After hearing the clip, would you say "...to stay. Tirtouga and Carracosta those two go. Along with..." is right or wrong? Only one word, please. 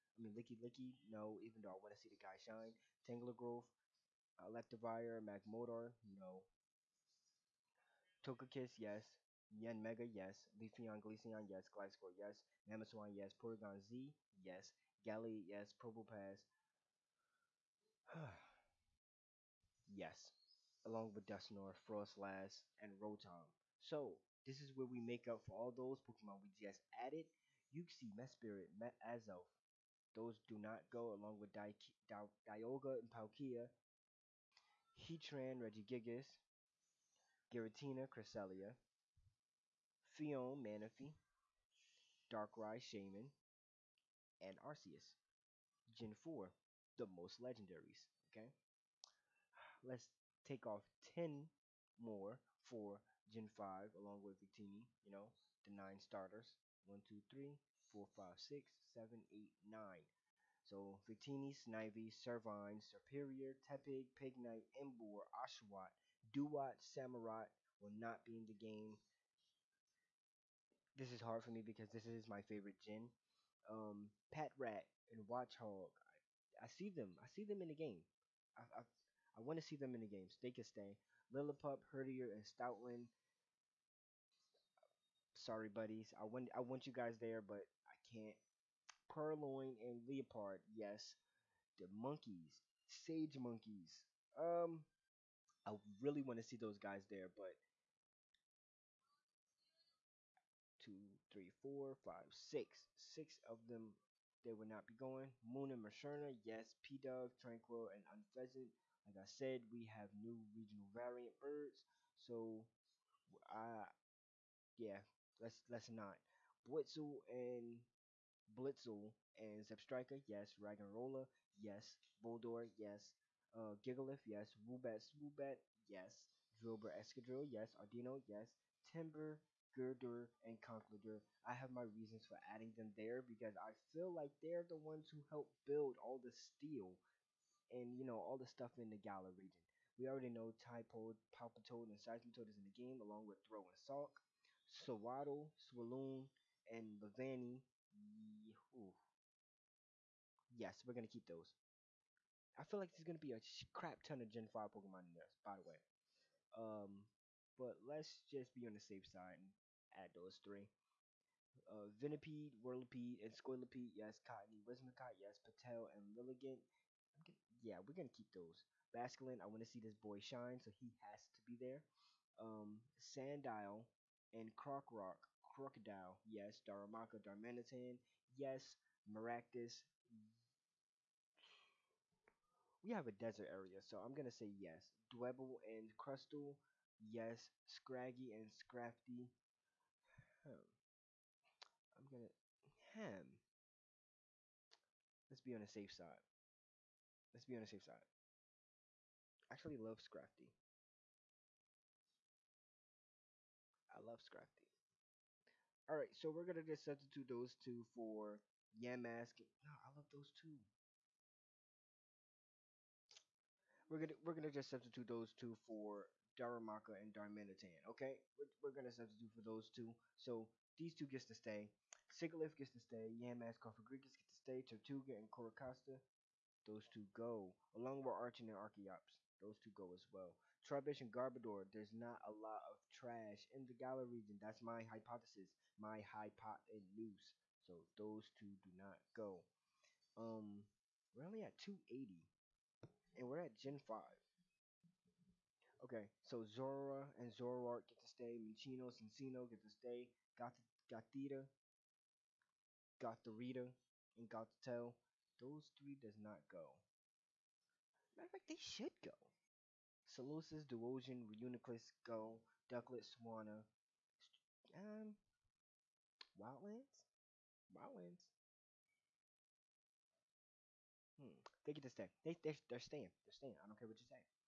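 right.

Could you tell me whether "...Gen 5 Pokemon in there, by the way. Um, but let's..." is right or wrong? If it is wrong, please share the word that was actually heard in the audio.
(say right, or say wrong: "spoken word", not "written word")
right.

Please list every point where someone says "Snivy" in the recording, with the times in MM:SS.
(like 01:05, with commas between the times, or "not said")
01:01.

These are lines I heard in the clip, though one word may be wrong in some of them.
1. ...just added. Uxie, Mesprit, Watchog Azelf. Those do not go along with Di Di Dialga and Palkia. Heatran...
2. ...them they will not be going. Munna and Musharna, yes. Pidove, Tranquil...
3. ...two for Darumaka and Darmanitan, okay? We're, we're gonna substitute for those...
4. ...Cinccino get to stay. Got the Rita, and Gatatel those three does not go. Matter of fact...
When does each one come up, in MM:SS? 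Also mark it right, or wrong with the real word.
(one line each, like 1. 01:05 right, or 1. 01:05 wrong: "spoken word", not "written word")
1. 00:26 wrong: "Met", not "Watchog"
2. 01:43 right
3. 03:35 right
4. 04:08 right.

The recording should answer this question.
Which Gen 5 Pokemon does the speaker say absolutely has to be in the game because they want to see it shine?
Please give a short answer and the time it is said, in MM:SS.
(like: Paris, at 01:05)
Basculin, at 02:48.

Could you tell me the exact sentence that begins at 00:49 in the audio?
Let's take off 10 more for Gen 5 along with Victini, you know, the nine starters.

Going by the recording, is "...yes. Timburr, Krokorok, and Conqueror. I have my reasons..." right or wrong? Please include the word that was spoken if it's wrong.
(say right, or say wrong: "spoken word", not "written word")
wrong: "Gurdurr", not "Krokorok".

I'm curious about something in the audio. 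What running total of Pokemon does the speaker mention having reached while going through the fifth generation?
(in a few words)
280.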